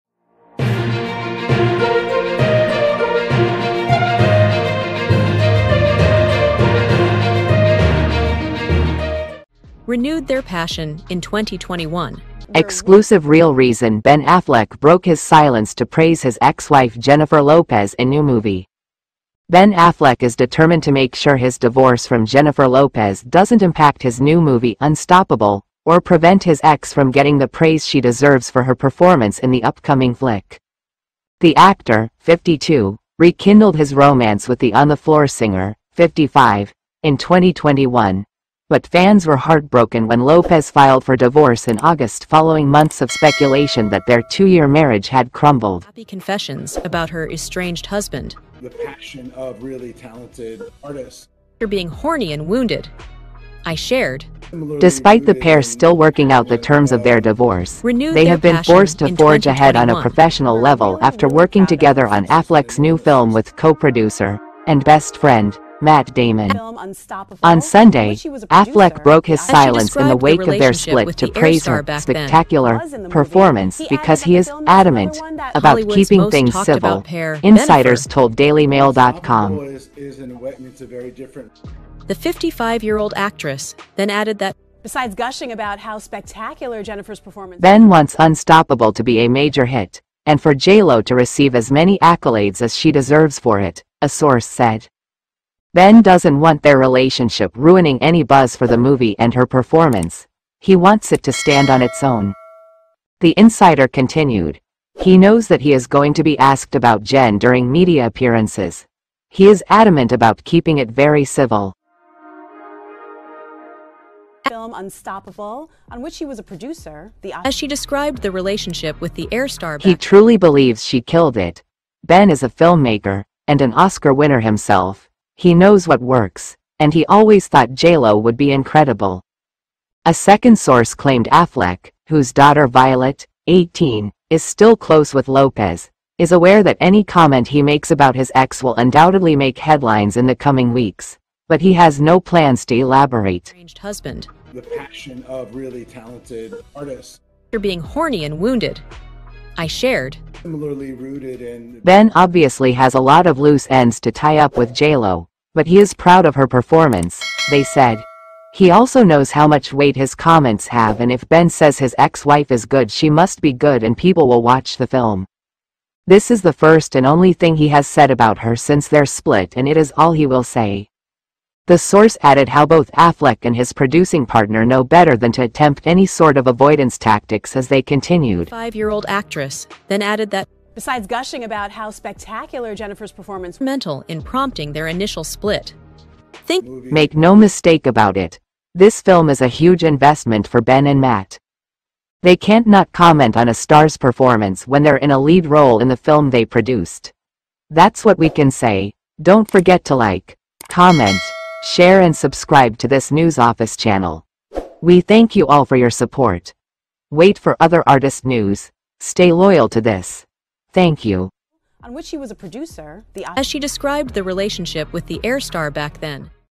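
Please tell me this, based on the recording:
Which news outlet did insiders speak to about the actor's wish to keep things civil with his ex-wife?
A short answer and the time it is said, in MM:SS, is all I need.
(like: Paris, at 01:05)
DailyMail.com, at 01:18.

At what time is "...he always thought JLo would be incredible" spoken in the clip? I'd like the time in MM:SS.
02:06.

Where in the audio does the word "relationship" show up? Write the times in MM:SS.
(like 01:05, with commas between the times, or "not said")
01:36, 01:58, 03:34.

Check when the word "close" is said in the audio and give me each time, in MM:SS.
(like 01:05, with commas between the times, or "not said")
02:14.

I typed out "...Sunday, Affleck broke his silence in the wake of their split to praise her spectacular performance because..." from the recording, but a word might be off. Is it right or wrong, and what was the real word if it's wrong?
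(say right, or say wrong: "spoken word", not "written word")
right.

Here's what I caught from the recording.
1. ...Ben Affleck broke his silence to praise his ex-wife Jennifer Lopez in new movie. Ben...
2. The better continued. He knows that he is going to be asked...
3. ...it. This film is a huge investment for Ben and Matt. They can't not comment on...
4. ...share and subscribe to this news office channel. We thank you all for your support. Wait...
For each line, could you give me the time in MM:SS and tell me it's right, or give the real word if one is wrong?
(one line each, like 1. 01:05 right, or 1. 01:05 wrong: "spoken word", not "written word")
1. 00:13 right
2. 01:43 wrong: "insider", not "better"
3. 03:08 right
4. 03:21 right.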